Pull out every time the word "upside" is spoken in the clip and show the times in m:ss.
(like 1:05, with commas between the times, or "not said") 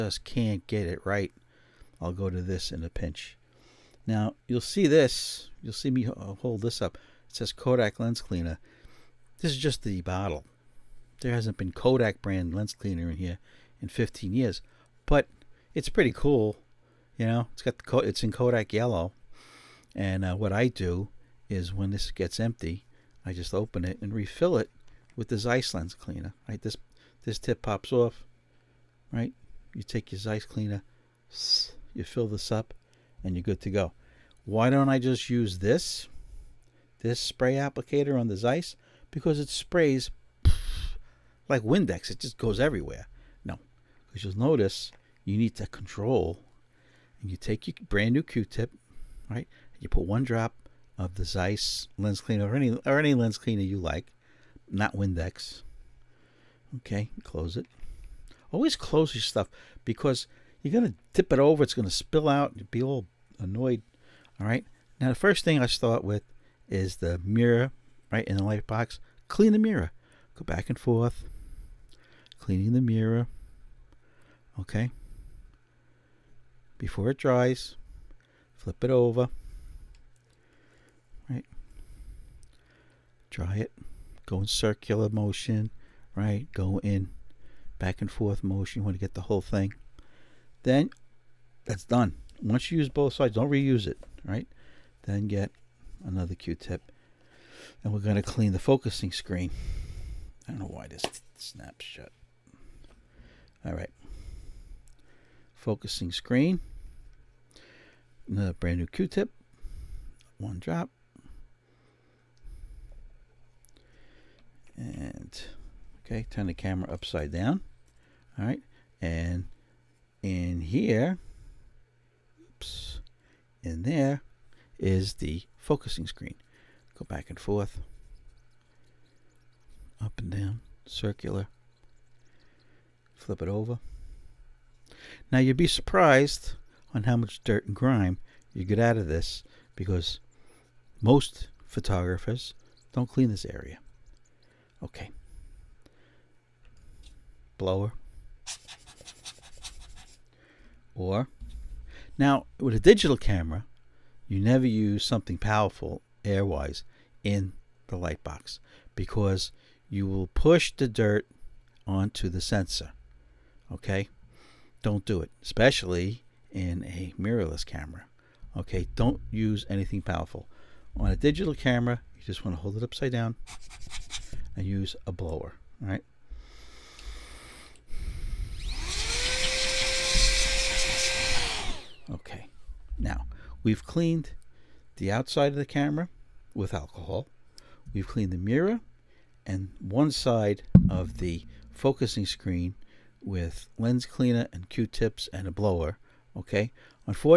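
1:56, 2:52.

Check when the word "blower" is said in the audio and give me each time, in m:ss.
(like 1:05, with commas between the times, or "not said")
2:27, 2:55, 3:15.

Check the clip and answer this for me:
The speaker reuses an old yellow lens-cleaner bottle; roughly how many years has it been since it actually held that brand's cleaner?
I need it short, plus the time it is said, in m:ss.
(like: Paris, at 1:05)
15, at 0:13.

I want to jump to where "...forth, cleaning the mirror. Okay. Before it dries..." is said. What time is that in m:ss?
1:10.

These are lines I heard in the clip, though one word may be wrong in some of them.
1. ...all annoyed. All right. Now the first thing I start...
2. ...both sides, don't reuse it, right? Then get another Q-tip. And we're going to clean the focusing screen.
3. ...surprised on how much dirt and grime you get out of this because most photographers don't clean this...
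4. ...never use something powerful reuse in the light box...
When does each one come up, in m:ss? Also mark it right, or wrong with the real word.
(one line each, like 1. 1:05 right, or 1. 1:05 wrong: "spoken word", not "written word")
1. 1:02 right
2. 1:32 right
3. 2:15 right
4. 2:34 wrong: "airwise", not "reuse".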